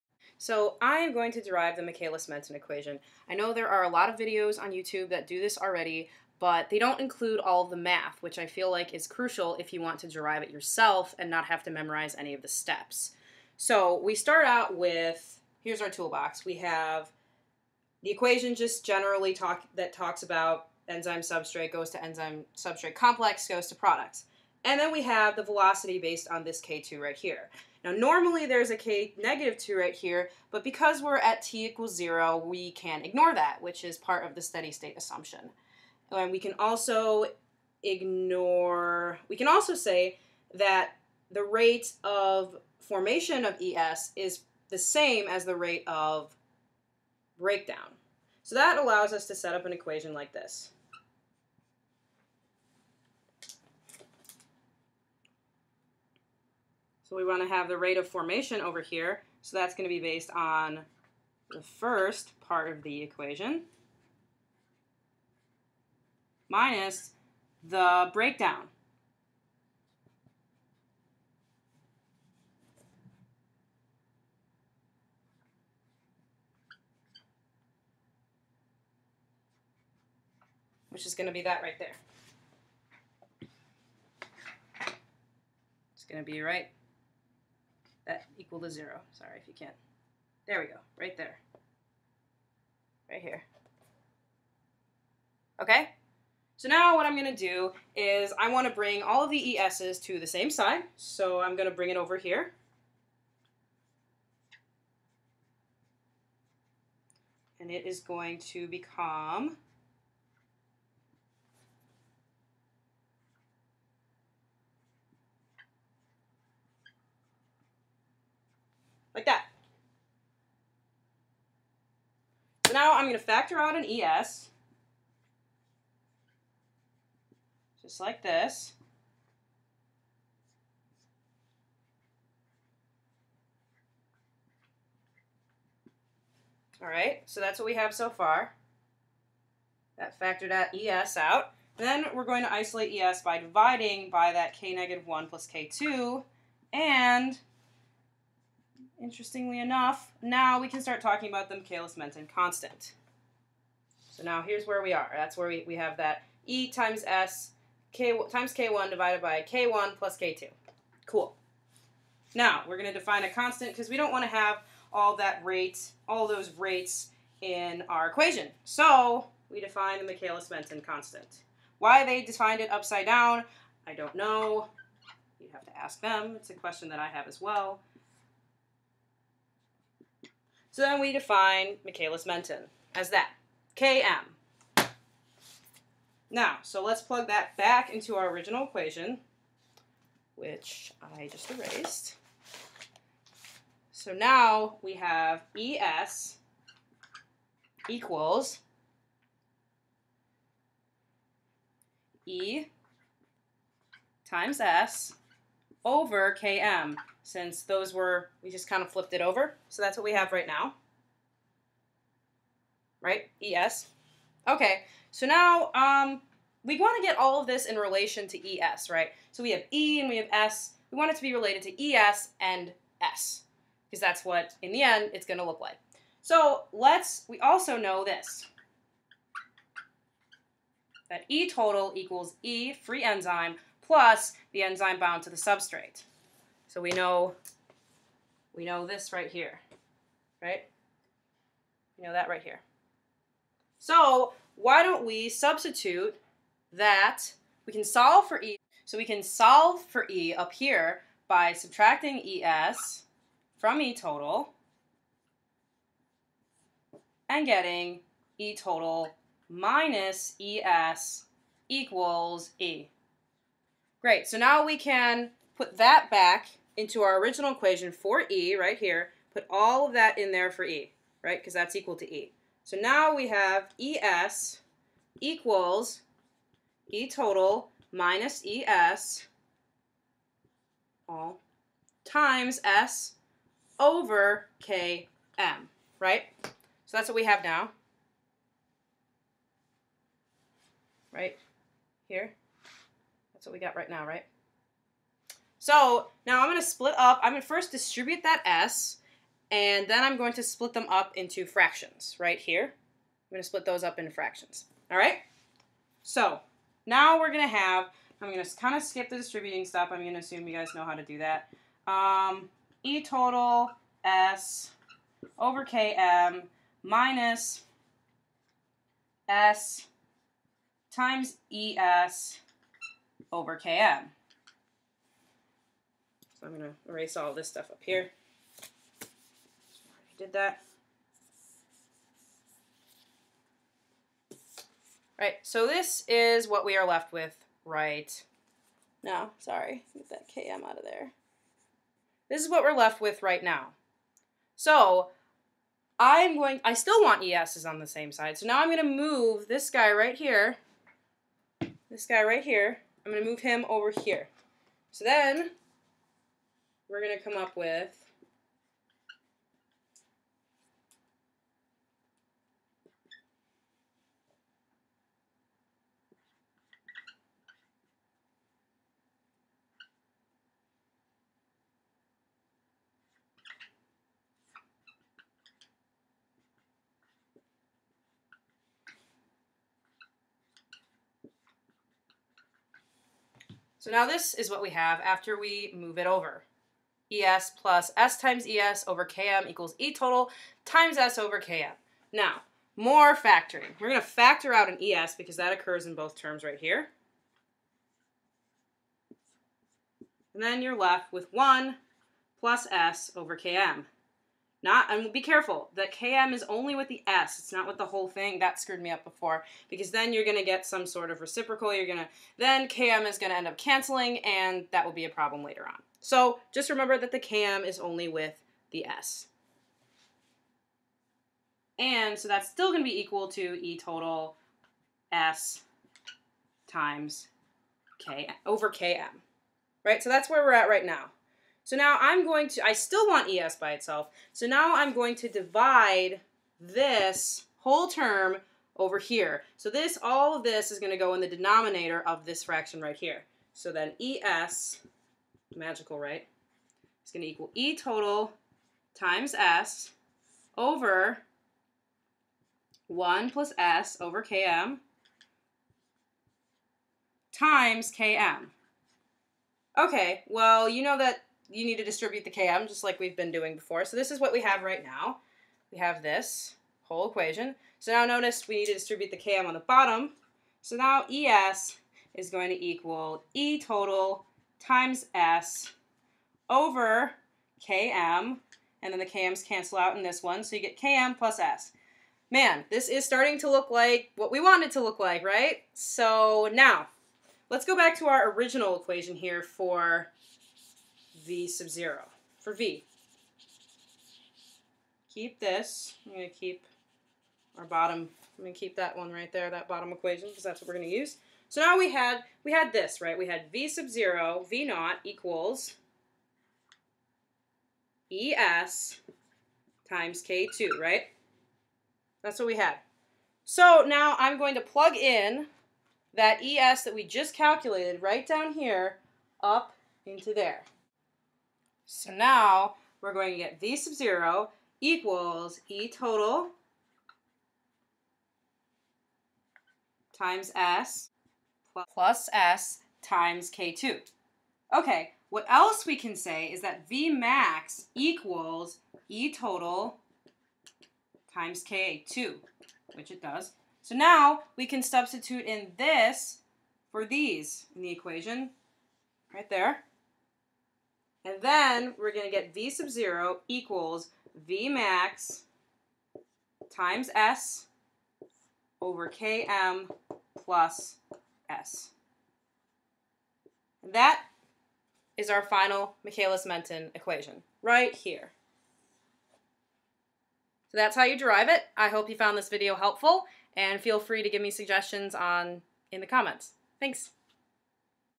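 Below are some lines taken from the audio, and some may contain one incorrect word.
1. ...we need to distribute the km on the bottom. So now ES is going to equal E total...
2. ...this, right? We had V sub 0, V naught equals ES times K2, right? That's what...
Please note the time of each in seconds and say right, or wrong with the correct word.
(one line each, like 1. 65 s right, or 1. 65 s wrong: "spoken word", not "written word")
1. 468 s right
2. 502 s right.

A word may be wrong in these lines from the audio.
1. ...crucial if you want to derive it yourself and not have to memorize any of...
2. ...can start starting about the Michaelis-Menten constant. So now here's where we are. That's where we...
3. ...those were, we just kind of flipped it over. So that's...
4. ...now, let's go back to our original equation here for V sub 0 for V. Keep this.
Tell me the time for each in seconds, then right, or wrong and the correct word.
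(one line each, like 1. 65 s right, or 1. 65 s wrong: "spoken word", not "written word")
1. 9 s right
2. 150 s wrong: "talking", not "starting"
3. 207 s right
4. 486 s right.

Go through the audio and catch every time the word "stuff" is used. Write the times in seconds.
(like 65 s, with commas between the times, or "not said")
309 s, 327 s.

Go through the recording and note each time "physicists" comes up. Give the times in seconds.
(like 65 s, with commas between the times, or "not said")
not said.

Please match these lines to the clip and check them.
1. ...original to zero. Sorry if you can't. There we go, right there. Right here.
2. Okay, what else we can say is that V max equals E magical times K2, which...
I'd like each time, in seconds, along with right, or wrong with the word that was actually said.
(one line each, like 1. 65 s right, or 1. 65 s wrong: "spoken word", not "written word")
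1. 88 s wrong: "equal", not "original"
2. 534 s wrong: "total", not "magical".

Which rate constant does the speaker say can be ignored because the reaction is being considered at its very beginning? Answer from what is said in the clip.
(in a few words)
k negative 2.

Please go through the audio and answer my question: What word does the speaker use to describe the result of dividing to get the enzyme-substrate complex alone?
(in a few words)
Magical.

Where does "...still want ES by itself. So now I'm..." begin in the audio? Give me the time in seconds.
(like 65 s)
432 s.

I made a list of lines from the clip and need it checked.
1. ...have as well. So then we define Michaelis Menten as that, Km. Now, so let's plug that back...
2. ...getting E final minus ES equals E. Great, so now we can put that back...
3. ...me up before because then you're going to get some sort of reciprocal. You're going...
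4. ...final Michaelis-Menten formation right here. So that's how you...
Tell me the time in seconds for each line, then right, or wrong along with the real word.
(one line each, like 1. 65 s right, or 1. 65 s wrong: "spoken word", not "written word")
1. 177 s right
2. 257 s wrong: "total", not "final"
3. 408 s right
4. 565 s wrong: "equation", not "formation".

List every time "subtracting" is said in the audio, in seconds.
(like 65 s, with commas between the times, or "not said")
251 s.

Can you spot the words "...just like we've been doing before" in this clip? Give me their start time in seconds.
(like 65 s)
462 s.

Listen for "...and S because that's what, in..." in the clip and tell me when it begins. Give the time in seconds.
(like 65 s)
222 s.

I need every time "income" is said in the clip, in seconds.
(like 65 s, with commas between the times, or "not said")
not said.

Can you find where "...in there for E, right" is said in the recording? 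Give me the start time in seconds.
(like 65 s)
270 s.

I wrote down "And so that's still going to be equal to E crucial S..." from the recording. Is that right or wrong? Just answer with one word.
wrong.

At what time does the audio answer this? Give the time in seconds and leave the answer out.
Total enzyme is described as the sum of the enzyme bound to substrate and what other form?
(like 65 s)
232 s.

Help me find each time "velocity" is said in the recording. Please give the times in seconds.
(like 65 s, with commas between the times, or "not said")
25 s.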